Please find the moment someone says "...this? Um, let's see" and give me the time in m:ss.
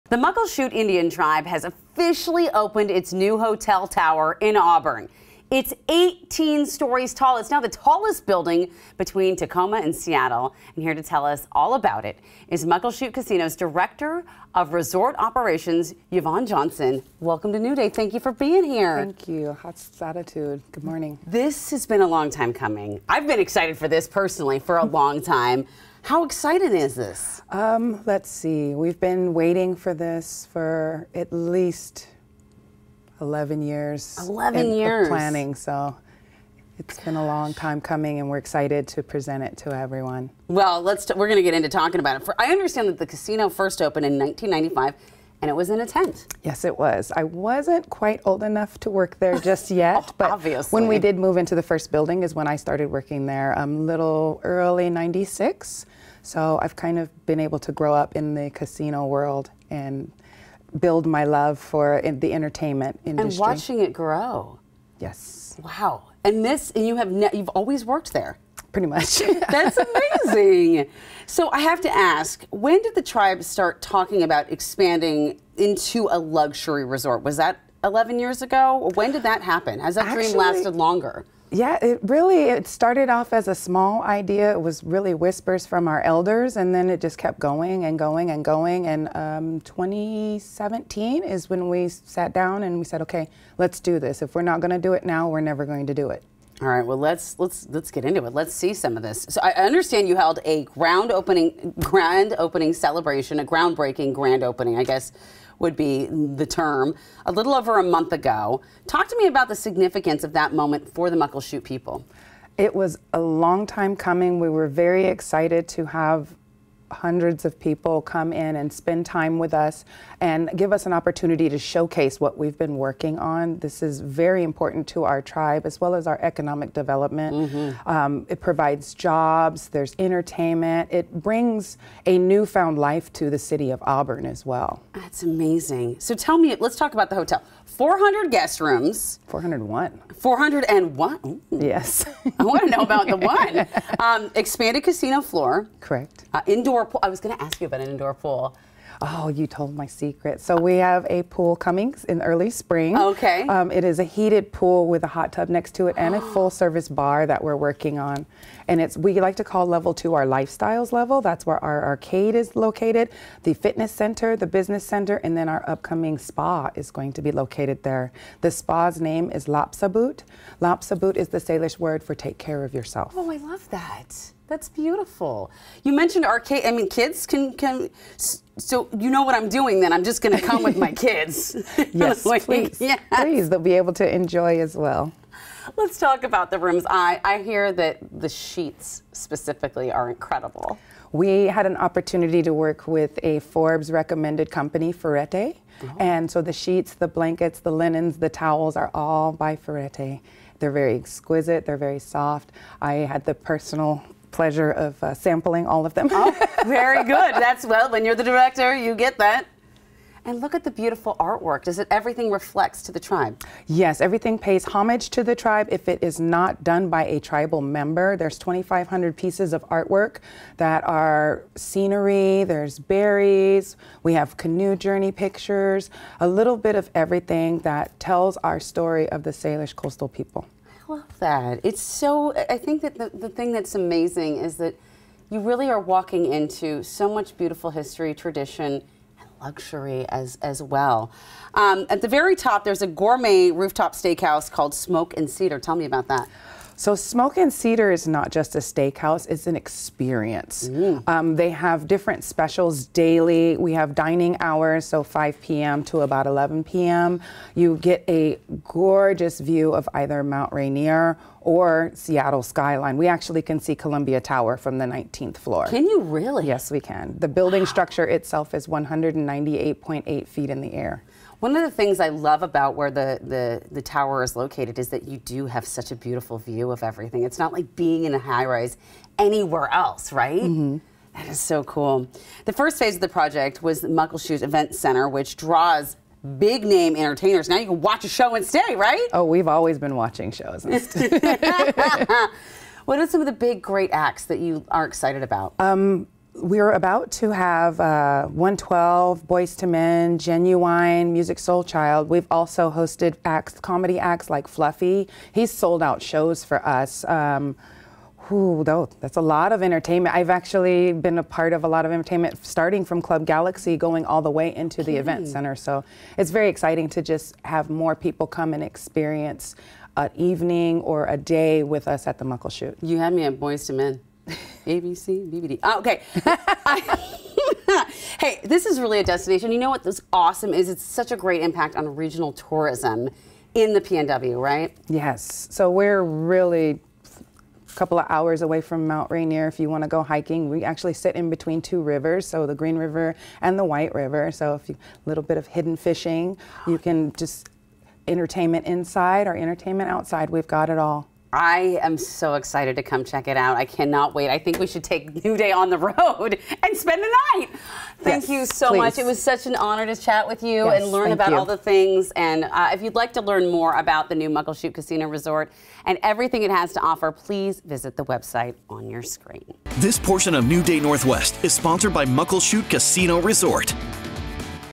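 0:26.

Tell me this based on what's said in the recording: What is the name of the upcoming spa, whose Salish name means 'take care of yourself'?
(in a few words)
Lapsabut.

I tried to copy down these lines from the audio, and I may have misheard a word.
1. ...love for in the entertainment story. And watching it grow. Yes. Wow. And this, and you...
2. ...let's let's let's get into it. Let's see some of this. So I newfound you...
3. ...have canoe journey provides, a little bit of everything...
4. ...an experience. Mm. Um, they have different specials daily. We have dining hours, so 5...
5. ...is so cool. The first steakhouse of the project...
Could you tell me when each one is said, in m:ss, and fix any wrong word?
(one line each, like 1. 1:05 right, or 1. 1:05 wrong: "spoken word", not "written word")
1. 1:01 wrong: "industry", not "story"
2. 1:36 wrong: "understand", not "newfound"
3. 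3:44 wrong: "pictures", not "provides"
4. 4:09 right
5. 4:41 wrong: "phase", not "steakhouse".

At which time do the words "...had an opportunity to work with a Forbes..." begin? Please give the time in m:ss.
3:11.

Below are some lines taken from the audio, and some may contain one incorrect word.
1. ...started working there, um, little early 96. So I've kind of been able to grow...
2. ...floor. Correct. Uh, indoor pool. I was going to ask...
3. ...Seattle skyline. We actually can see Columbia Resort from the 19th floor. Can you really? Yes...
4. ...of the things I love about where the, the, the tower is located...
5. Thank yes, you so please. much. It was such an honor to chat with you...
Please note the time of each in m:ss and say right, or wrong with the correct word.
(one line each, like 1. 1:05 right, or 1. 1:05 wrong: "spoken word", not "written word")
1. 0:52 right
2. 2:25 right
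3. 4:21 wrong: "Tower", not "Resort"
4. 4:31 right
5. 5:57 right.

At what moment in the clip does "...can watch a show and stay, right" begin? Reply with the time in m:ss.
4:47.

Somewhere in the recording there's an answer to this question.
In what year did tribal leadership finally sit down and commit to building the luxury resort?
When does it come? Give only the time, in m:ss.
1:29.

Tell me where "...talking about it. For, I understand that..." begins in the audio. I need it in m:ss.
0:41.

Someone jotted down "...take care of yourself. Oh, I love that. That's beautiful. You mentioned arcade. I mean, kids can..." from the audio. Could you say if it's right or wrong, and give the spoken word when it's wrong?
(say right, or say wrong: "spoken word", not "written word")
right.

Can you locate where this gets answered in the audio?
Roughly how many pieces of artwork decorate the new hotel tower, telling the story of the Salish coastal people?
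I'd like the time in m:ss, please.
3:38.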